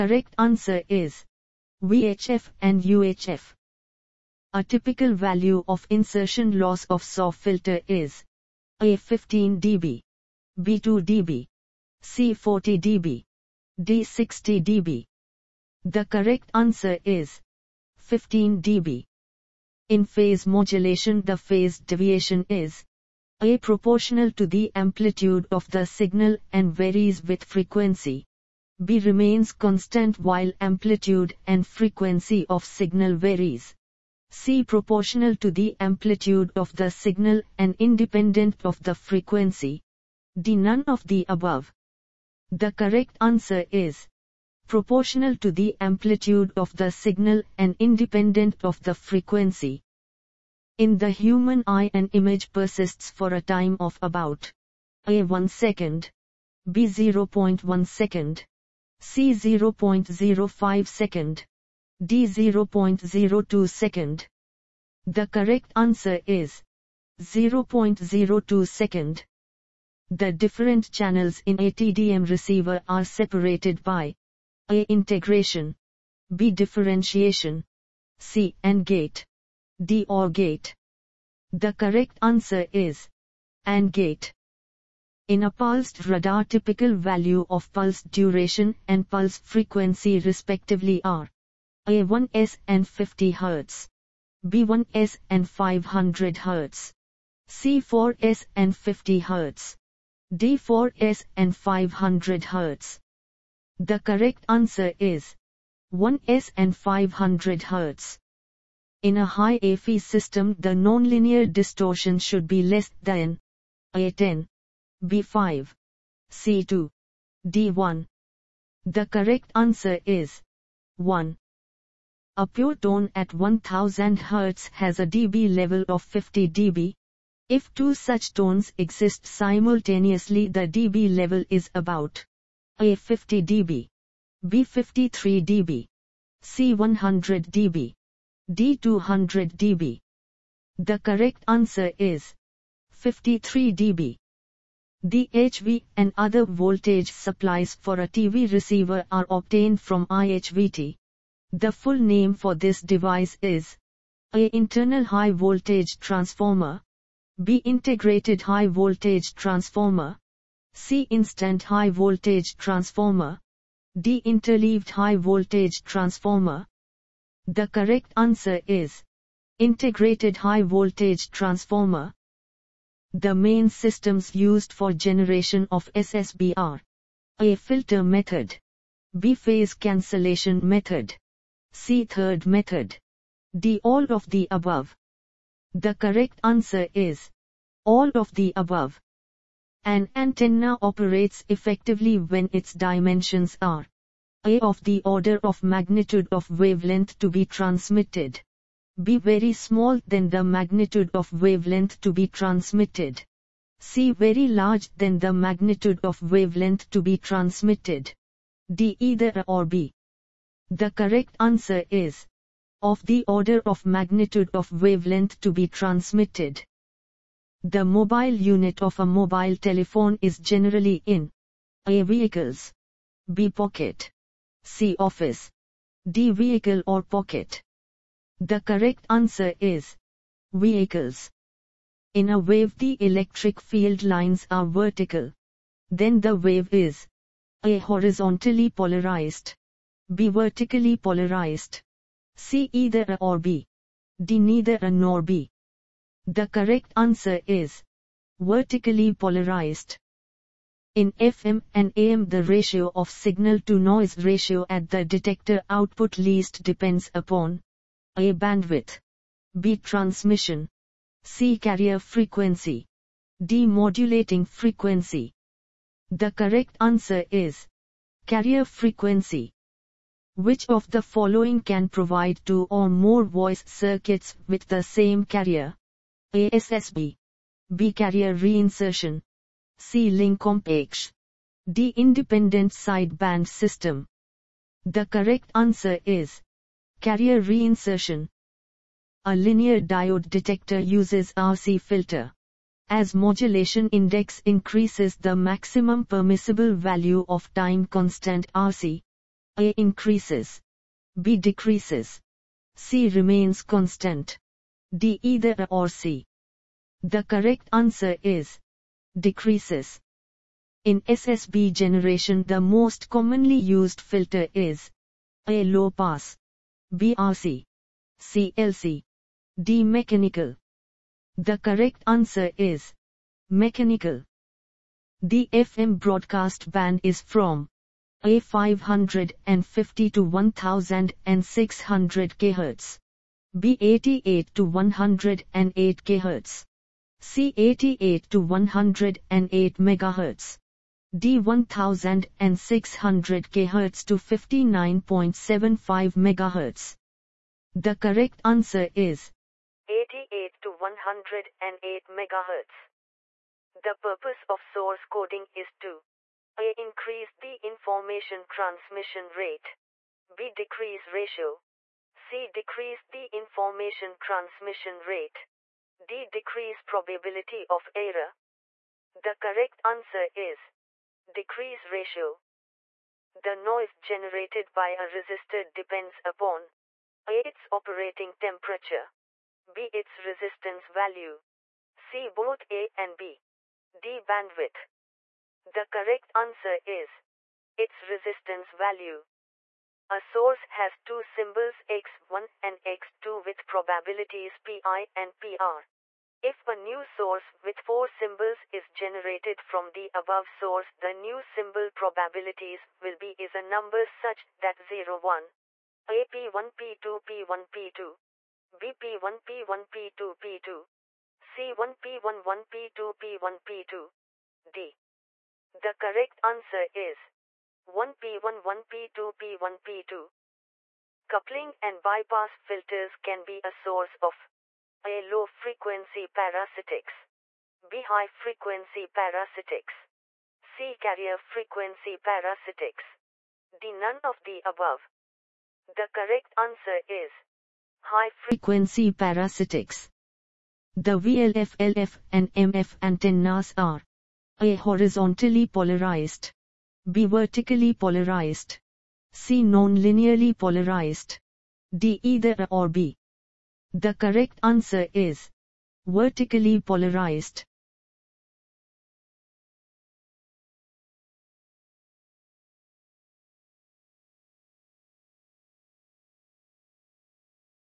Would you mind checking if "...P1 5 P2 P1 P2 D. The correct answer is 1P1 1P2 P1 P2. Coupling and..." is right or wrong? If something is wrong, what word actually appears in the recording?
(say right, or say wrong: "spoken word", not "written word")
wrong: "1", not "5".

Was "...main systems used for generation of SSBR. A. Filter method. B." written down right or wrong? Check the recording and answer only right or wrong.
right.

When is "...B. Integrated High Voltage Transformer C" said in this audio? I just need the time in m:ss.
2:37.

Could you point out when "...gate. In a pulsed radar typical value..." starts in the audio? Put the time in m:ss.
1:23.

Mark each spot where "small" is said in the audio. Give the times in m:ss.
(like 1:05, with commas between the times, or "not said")
3:19.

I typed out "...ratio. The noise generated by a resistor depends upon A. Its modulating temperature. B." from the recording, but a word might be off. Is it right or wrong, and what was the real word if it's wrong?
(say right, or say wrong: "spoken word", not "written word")
wrong: "operating", not "modulating".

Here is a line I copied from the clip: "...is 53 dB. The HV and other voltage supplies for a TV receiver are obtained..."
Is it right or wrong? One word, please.
right.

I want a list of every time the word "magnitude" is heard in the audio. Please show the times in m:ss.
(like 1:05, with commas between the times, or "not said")
3:15, 3:20, 3:25, 3:33.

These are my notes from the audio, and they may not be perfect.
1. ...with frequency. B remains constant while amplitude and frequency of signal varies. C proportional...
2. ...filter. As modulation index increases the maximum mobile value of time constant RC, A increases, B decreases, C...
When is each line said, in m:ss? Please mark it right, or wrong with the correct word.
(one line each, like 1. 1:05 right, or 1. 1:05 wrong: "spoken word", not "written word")
1. 0:27 right
2. 4:51 wrong: "permissible", not "mobile".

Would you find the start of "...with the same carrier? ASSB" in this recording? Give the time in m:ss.
4:34.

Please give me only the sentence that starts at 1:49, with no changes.
In a high AF system the nonlinear distortion should be less than A10, B5, C2, D1.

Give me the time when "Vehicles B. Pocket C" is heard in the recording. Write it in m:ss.
3:42.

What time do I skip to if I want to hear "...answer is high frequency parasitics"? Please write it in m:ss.
7:16.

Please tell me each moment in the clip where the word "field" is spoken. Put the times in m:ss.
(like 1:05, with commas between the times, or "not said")
3:53.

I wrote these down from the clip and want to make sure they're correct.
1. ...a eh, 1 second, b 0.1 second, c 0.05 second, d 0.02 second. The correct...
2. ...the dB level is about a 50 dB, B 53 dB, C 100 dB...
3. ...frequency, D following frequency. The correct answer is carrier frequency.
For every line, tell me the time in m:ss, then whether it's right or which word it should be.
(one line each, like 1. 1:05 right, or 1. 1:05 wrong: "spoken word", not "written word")
1. 0:55 right
2. 2:10 right
3. 4:21 wrong: "modulating", not "following".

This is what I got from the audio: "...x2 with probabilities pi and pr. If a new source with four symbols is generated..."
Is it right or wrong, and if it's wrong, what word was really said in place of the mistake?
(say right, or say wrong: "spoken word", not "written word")
right.